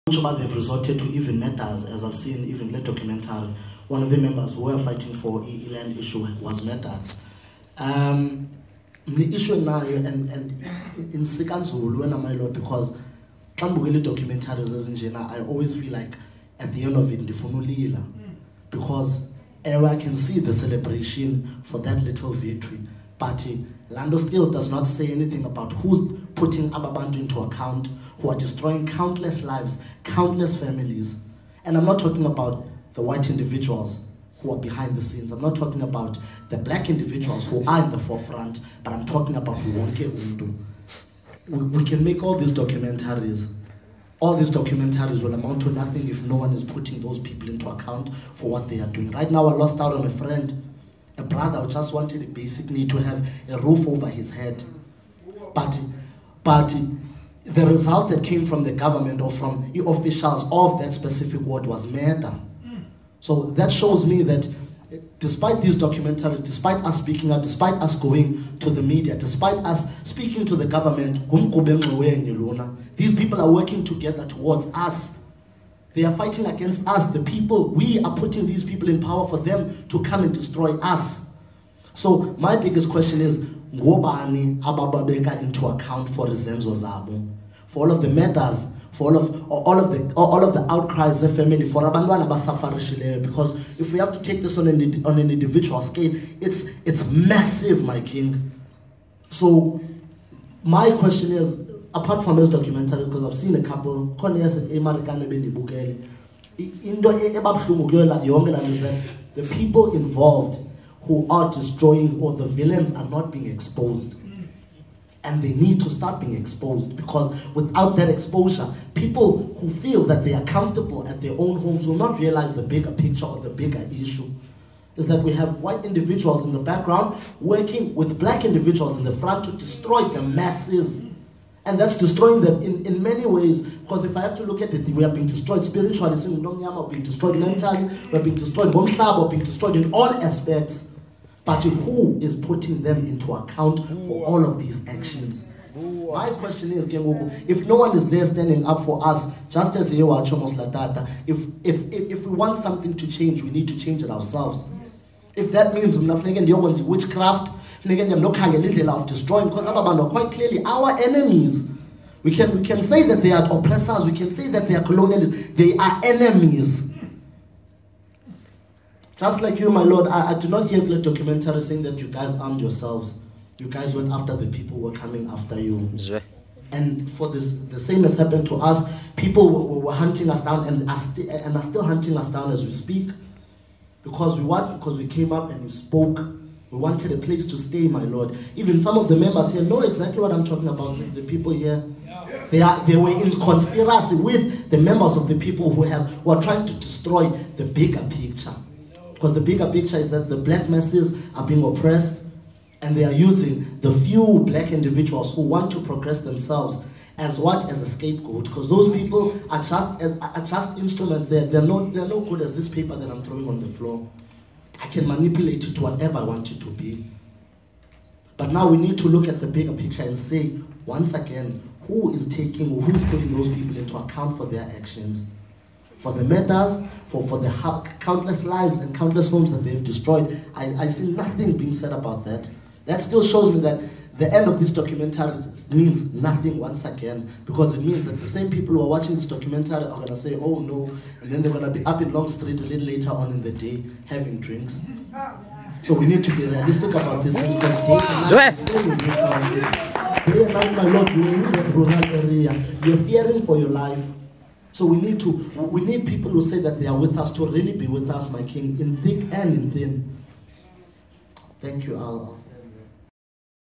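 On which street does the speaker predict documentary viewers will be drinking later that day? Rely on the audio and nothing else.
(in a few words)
Long Street.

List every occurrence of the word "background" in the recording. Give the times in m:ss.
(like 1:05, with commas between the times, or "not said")
2:06.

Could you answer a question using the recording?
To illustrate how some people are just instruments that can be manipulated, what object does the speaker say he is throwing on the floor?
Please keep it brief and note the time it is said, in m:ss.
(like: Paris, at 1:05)
paper, at 3:32.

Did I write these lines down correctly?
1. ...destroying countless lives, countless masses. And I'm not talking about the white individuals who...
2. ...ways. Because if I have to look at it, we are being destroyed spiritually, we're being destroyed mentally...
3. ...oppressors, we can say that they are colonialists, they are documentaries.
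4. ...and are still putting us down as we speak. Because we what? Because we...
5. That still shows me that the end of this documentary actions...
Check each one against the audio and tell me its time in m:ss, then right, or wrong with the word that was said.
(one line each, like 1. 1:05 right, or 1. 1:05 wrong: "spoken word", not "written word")
1. 0:28 wrong: "families", not "masses"
2. 2:13 right
3. 2:43 wrong: "enemies", not "documentaries"
4. 3:01 wrong: "hunting", not "putting"
5. 3:52 wrong: "means", not "actions".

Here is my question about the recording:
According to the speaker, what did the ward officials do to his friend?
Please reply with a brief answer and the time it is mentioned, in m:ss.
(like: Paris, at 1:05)
murder, at 1:01.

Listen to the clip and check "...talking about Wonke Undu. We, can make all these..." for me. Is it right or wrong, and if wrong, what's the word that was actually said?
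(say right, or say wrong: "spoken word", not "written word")
right.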